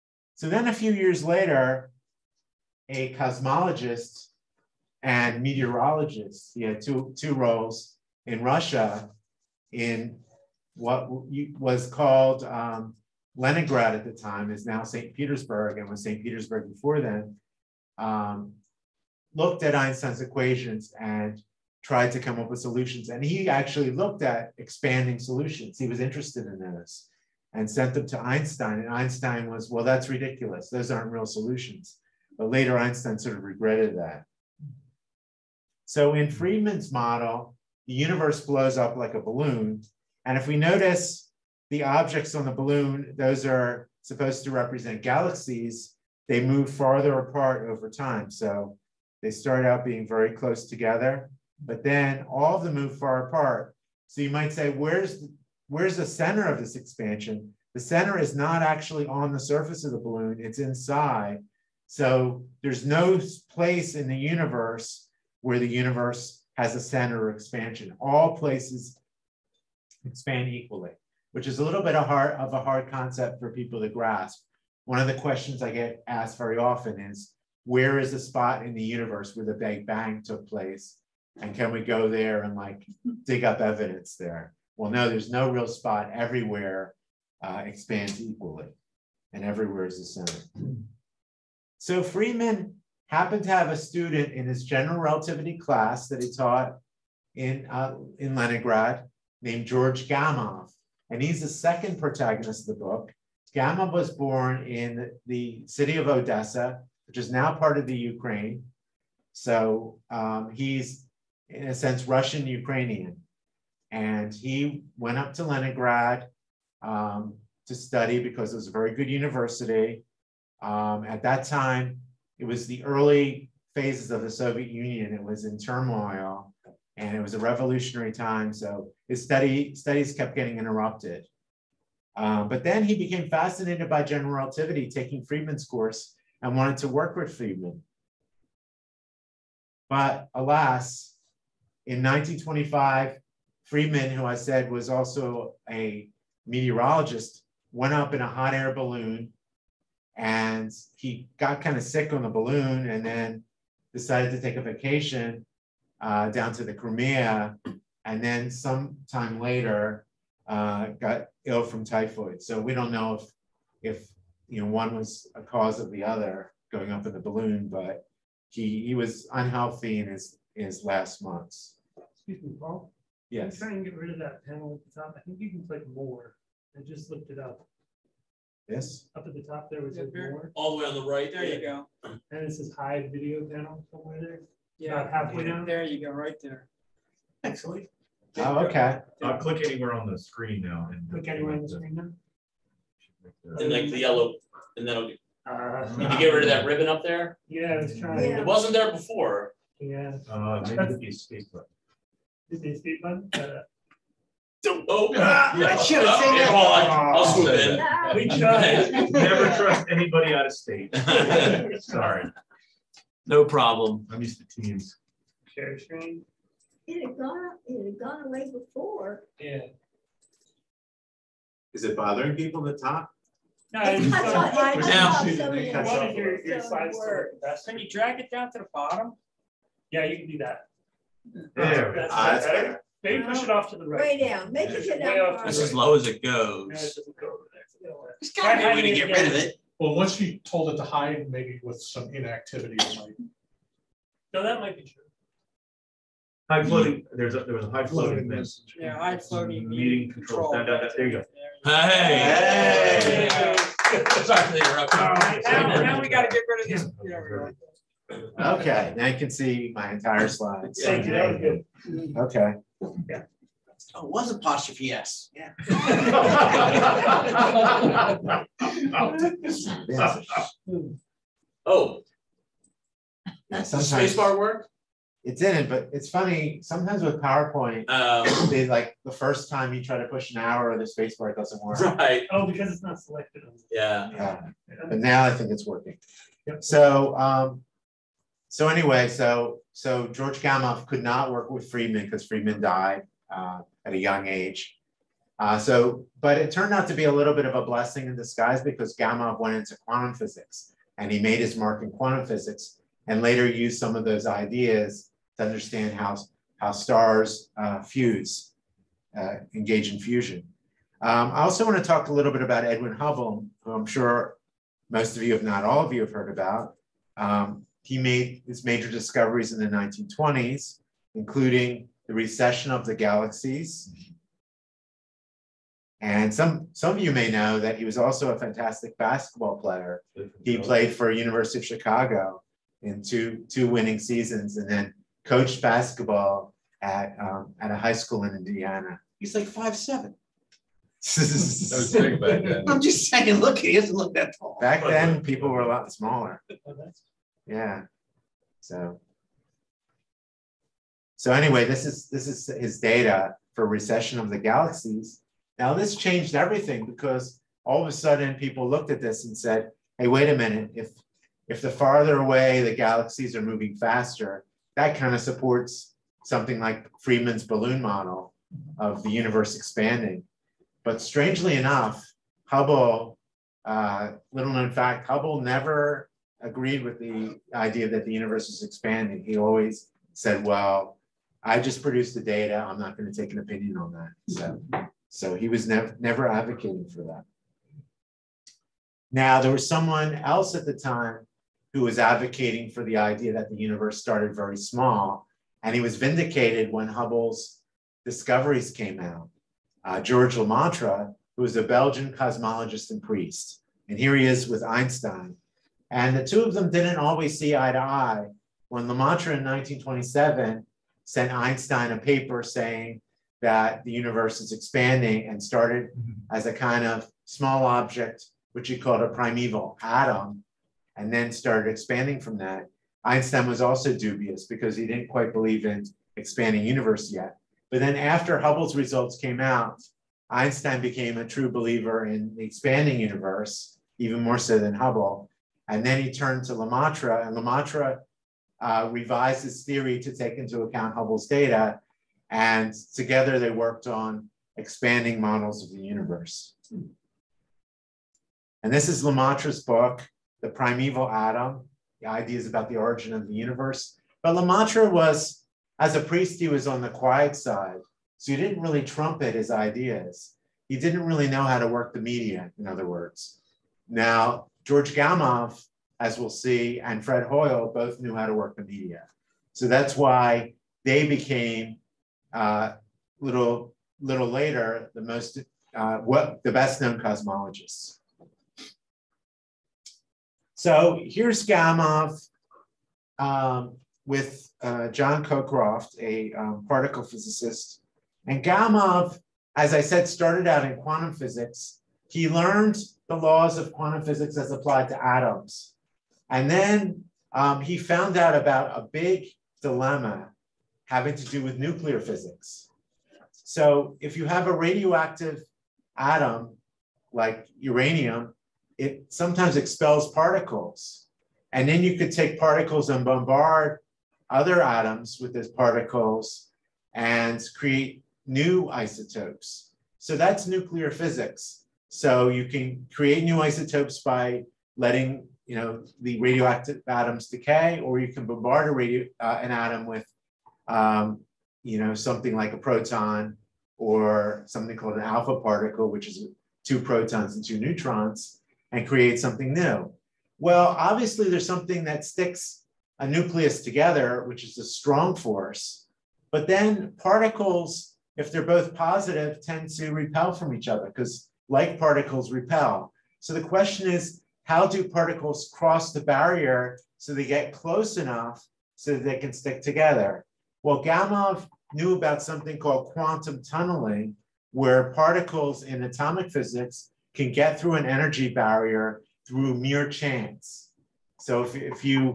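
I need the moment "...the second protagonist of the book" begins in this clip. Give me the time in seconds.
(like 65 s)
101 s.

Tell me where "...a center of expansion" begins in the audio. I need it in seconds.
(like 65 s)
66 s.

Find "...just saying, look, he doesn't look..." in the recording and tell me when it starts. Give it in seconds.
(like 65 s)
342 s.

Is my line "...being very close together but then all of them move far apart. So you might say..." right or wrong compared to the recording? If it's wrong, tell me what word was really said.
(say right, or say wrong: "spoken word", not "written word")
right.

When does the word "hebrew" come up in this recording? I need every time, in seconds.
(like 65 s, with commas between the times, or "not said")
not said.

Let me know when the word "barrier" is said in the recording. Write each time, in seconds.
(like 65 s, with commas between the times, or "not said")
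556 s, 568 s.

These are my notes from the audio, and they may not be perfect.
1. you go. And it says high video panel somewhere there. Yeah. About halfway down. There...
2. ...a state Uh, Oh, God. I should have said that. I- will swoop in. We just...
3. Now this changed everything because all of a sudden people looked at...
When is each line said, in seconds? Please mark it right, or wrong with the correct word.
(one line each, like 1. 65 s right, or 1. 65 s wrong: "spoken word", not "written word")
1. 181 s right
2. 202 s right
3. 355 s right.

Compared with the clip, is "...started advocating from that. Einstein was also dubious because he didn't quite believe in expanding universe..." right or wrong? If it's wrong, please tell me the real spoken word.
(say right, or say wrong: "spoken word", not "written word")
wrong: "expanding", not "advocating".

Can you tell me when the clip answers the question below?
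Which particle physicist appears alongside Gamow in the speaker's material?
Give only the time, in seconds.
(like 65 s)
484 s.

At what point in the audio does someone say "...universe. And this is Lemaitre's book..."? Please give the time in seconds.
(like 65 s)
445 s.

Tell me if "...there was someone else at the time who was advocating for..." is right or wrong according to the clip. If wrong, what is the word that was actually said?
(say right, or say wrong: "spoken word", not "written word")
right.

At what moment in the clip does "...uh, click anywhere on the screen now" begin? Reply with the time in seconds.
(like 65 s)
189 s.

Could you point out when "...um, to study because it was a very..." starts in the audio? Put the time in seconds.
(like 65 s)
116 s.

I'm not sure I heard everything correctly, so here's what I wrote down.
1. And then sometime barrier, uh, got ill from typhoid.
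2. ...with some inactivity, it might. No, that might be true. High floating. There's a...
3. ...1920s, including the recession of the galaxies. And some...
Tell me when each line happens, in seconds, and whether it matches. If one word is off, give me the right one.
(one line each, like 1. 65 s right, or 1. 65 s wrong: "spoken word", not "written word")
1. 158 s wrong: "later", not "barrier"
2. 241 s right
3. 319 s right.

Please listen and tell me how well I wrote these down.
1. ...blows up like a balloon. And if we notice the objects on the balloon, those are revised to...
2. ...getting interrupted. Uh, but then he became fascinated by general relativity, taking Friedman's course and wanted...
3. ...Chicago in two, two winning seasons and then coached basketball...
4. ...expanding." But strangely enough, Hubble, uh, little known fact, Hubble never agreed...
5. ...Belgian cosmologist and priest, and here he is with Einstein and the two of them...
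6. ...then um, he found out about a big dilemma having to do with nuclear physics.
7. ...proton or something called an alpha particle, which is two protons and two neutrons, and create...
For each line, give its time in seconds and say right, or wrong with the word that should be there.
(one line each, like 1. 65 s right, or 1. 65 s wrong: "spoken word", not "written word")
1. 38 s wrong: "supposed", not "revised"
2. 130 s right
3. 331 s right
4. 369 s right
5. 401 s right
6. 496 s right
7. 532 s right.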